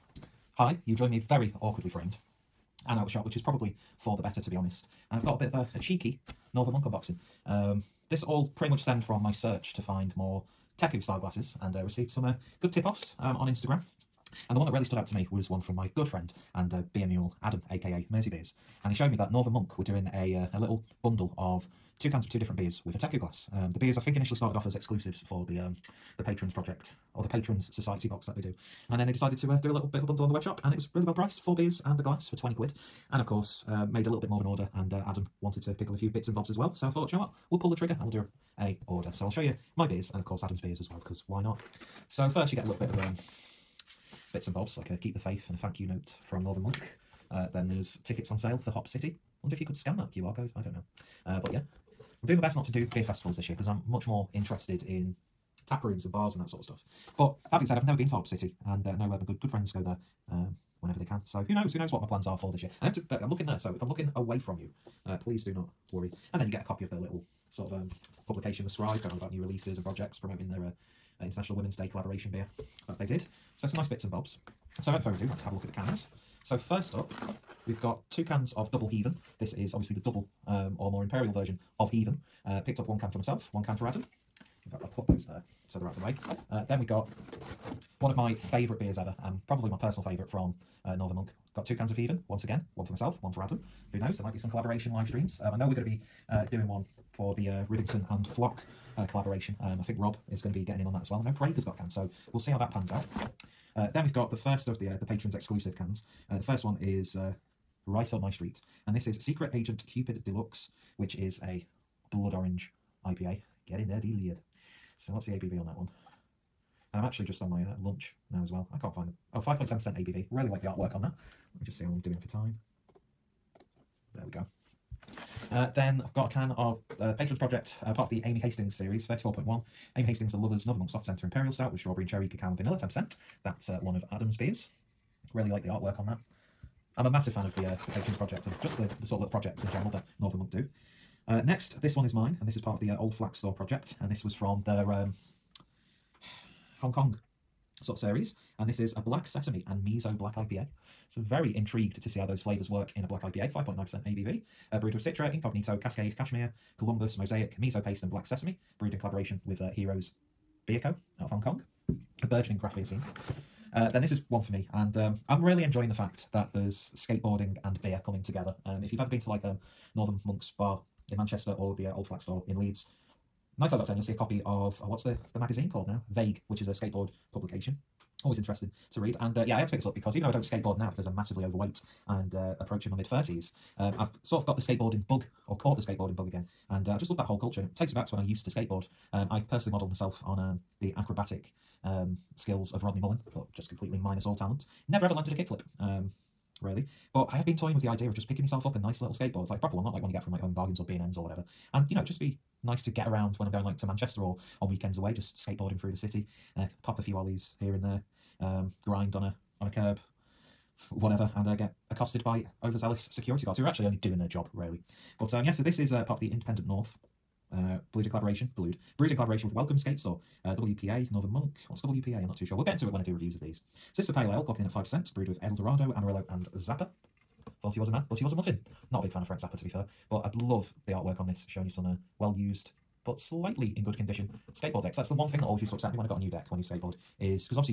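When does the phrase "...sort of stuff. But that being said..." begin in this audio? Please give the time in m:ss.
0:56.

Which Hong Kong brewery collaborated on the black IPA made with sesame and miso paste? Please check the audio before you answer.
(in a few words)
Heroes Beer Co.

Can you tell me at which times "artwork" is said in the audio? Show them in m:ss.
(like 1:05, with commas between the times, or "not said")
2:00, 2:15, 3:50.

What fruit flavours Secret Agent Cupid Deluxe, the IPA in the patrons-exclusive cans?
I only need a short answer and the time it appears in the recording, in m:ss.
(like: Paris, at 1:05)
blood orange, at 1:52.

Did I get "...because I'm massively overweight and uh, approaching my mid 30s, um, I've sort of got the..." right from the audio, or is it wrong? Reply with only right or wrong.
right.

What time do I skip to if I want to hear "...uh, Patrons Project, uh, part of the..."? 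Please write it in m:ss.
2:06.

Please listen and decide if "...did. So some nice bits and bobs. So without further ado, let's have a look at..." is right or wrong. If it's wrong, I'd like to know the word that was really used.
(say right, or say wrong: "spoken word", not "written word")
right.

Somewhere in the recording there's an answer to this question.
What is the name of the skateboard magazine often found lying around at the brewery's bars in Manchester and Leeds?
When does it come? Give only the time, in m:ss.
2:56.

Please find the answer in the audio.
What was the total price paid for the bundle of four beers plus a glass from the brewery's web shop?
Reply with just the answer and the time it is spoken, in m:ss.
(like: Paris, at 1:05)
20 quid, at 0:32.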